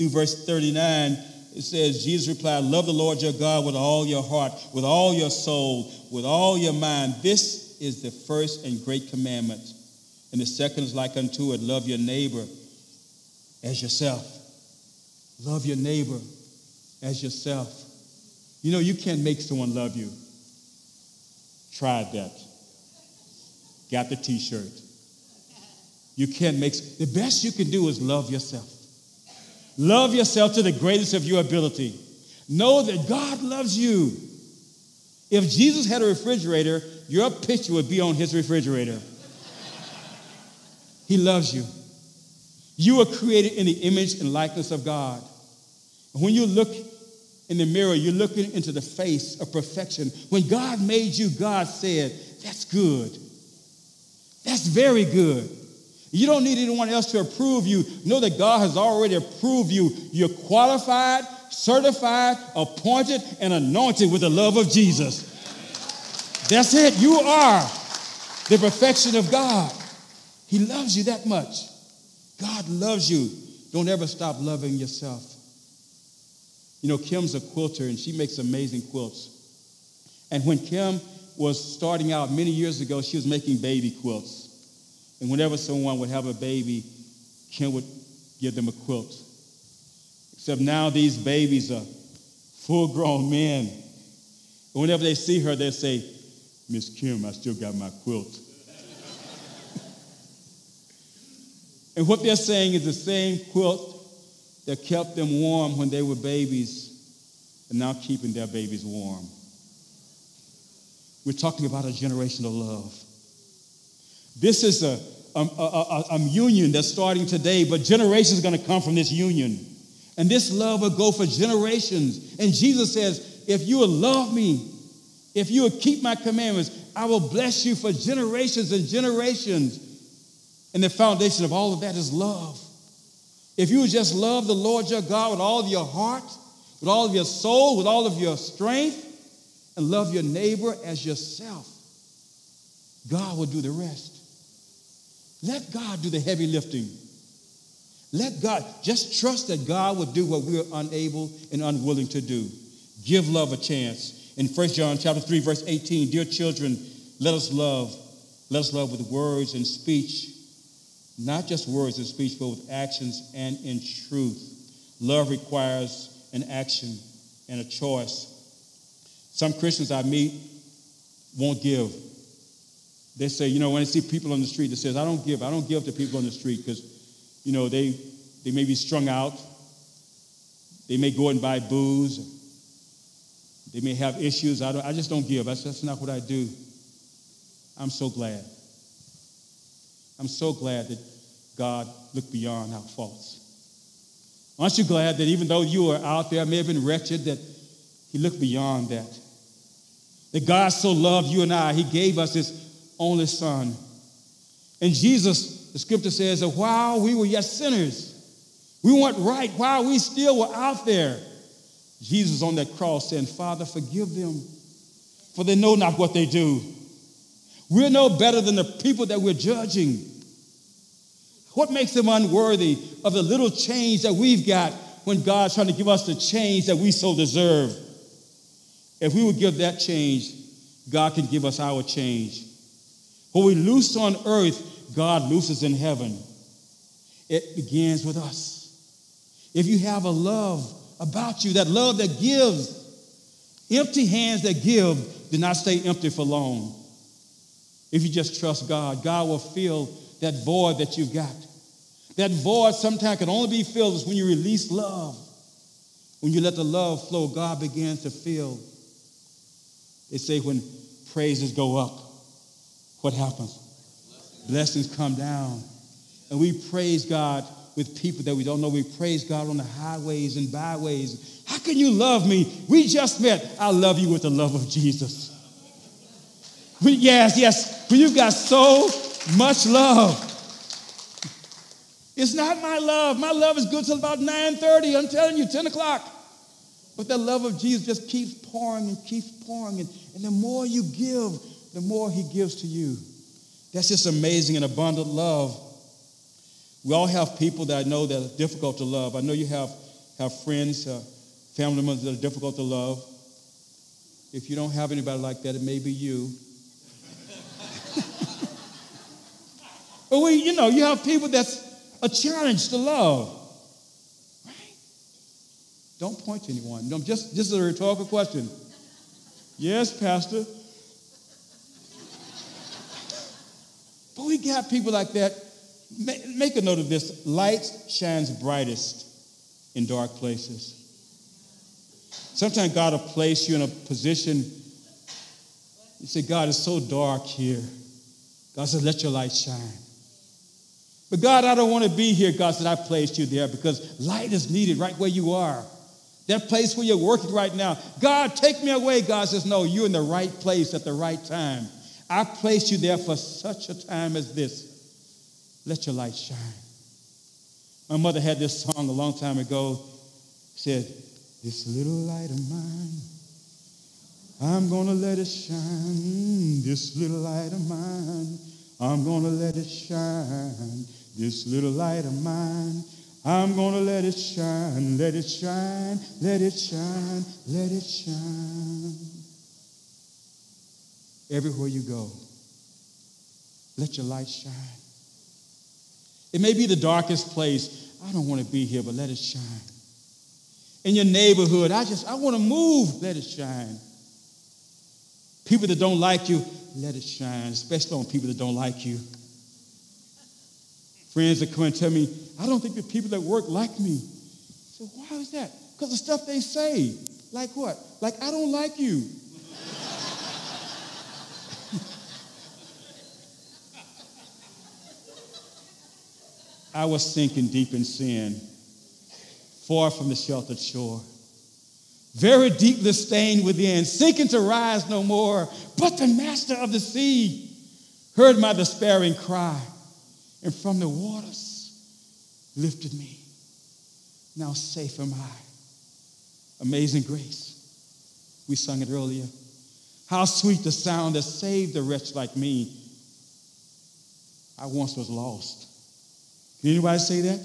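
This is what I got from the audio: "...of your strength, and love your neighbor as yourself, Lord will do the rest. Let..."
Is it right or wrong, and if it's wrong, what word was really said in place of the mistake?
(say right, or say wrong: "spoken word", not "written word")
wrong: "God", not "Lord".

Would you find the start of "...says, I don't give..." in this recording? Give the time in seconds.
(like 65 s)
174 s.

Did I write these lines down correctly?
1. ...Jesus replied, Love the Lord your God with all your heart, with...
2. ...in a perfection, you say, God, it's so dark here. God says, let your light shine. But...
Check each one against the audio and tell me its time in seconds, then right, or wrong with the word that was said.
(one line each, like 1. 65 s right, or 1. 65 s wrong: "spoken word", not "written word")
1. 2 s right
2. 333 s wrong: "position", not "perfection".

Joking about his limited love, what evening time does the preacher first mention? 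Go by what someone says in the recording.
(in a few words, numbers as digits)
9:30.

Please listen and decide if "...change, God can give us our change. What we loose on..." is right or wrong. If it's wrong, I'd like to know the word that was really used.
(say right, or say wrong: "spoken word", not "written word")
right.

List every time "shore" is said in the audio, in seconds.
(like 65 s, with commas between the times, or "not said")
420 s.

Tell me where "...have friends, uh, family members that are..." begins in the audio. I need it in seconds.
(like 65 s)
300 s.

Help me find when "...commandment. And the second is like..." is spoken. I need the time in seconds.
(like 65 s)
9 s.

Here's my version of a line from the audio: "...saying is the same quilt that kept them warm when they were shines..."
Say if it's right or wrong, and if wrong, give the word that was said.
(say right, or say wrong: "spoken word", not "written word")
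wrong: "babies", not "shines".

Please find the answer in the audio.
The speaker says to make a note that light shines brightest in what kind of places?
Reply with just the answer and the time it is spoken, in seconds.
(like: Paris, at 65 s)
Dark places, at 329 s.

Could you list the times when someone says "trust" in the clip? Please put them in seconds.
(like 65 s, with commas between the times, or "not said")
149 s, 248 s.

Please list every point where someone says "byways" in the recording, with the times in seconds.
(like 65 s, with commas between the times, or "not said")
270 s.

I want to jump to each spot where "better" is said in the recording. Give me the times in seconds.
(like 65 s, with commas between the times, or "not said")
218 s.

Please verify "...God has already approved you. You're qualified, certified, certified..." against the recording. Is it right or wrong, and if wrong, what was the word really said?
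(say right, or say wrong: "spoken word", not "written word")
wrong: "appointed", not "certified".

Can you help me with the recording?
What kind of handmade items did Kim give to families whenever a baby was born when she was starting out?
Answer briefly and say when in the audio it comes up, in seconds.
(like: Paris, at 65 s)
Baby quilts, at 83 s.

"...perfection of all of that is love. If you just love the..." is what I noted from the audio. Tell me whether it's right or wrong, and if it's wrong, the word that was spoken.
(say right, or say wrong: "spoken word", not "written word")
wrong: "foundation", not "perfection".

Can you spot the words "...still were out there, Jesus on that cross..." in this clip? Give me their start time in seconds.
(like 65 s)
209 s.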